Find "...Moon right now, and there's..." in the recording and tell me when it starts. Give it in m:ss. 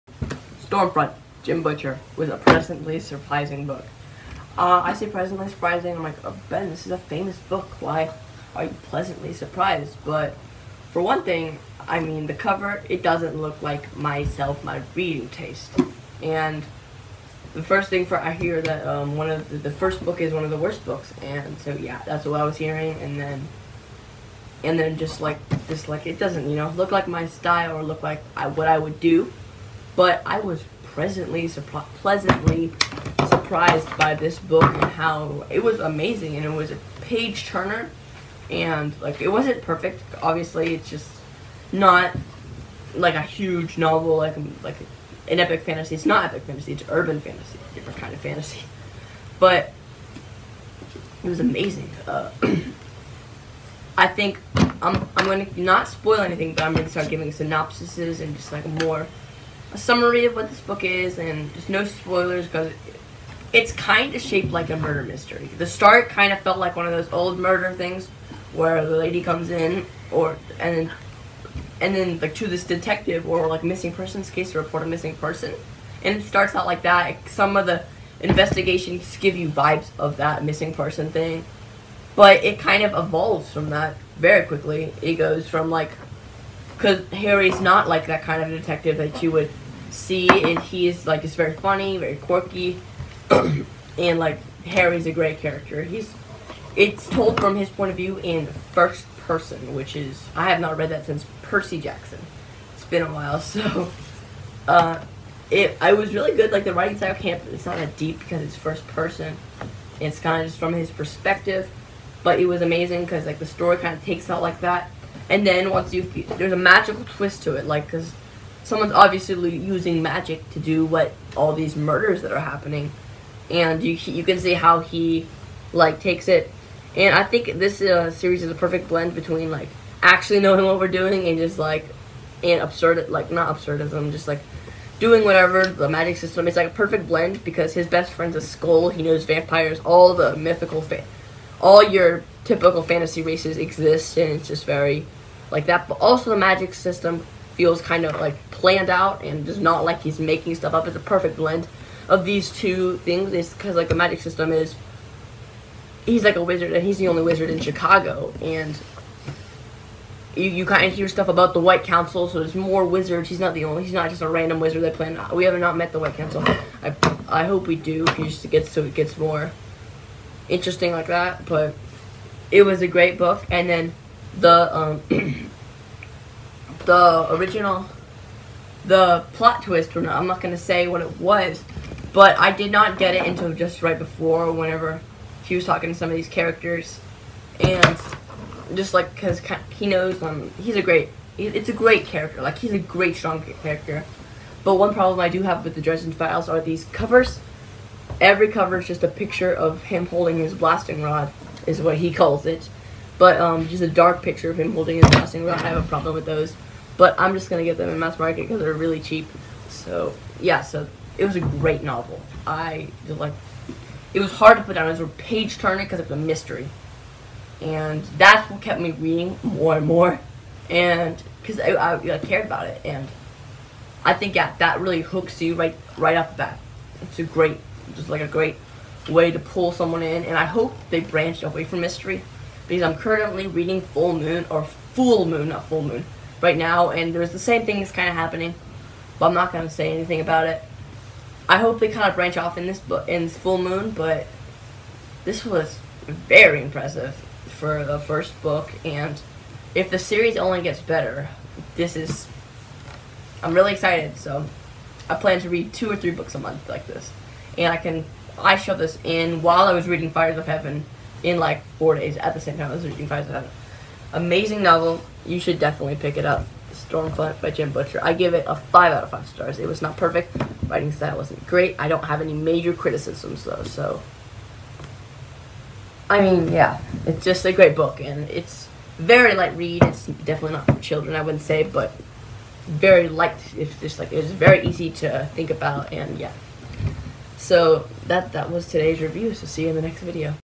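3:55.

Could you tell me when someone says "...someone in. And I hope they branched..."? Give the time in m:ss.
3:49.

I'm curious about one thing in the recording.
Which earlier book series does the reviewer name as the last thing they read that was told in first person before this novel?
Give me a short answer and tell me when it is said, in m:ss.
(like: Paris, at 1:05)
Percy Jackson, at 1:41.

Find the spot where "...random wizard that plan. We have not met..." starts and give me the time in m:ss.
2:44.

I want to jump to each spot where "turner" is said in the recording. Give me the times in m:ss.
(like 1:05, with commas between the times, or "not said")
0:37, 3:35.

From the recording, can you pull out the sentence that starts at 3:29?
So, yeah, so it was a great novel.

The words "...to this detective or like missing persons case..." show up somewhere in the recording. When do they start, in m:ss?
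1:12.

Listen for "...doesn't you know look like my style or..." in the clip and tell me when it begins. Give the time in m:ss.
0:26.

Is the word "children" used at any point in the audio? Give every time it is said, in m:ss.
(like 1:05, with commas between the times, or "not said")
4:40.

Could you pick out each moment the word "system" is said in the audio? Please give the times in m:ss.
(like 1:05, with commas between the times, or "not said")
2:16, 2:26, 2:34.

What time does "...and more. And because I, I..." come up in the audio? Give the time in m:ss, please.
3:39.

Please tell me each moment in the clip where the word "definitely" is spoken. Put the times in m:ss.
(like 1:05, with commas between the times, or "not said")
4:25, 4:40.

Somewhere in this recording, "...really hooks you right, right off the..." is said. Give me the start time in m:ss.
3:44.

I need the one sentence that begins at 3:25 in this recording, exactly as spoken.
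I have a problem with those.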